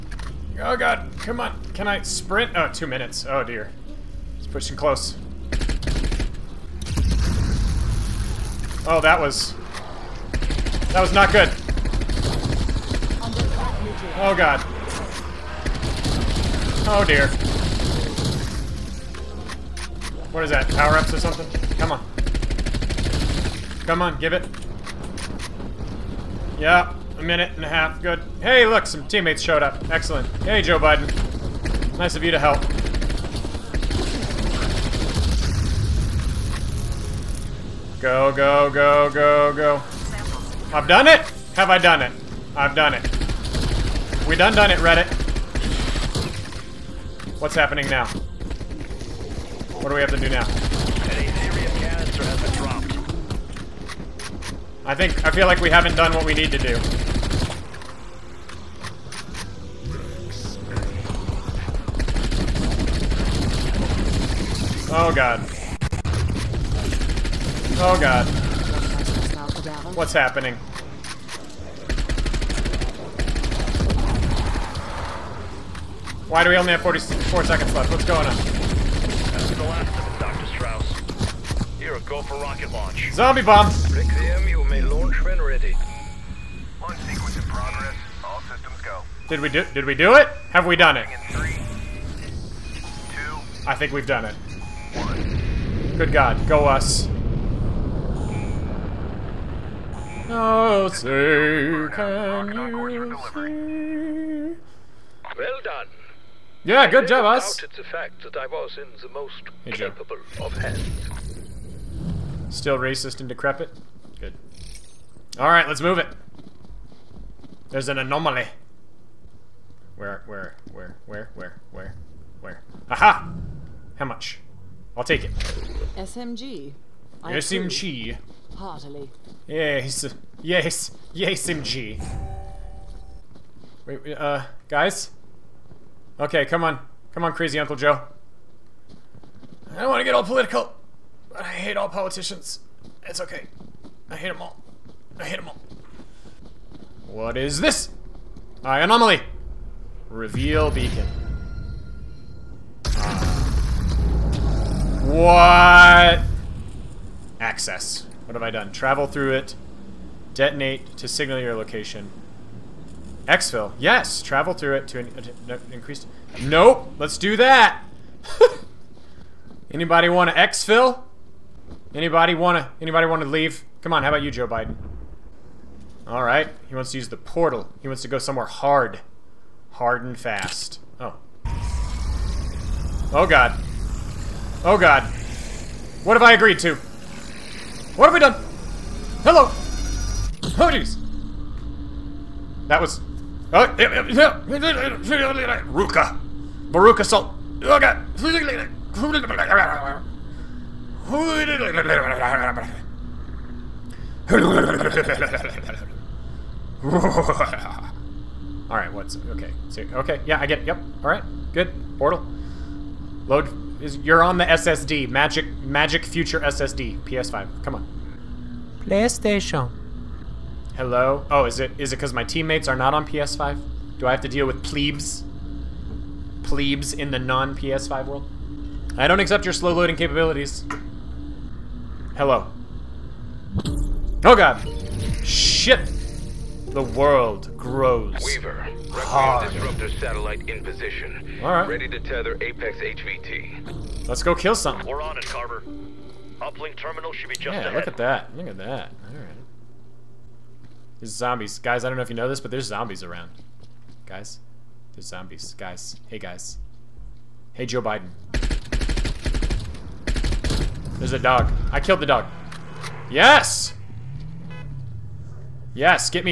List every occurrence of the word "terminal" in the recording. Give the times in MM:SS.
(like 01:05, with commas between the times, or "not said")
04:06.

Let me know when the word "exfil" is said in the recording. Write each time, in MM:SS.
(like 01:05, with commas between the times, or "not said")
02:43, 02:50.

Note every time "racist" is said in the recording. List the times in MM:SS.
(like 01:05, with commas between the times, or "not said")
01:52.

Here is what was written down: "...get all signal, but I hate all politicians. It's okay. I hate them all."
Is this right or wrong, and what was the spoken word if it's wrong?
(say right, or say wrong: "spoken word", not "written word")
wrong: "political", not "signal".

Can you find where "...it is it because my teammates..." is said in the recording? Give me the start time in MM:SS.
03:41.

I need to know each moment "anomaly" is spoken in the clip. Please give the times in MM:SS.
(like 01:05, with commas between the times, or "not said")
01:57, 02:28.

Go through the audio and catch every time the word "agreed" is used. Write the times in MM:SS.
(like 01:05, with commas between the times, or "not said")
03:06.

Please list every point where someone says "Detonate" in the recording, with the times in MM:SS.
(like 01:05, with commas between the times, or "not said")
02:40.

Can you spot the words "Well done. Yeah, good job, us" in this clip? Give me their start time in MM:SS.
01:45.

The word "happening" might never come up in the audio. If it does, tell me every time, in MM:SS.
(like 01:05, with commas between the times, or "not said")
00:47, 01:10.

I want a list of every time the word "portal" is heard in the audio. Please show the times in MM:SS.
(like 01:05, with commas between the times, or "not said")
02:57, 03:31.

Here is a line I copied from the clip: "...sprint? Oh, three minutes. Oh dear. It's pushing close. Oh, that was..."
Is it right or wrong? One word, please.
wrong.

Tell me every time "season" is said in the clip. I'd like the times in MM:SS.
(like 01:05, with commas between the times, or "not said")
not said.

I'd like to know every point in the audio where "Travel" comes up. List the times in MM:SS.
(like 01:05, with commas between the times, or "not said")
02:38, 02:44.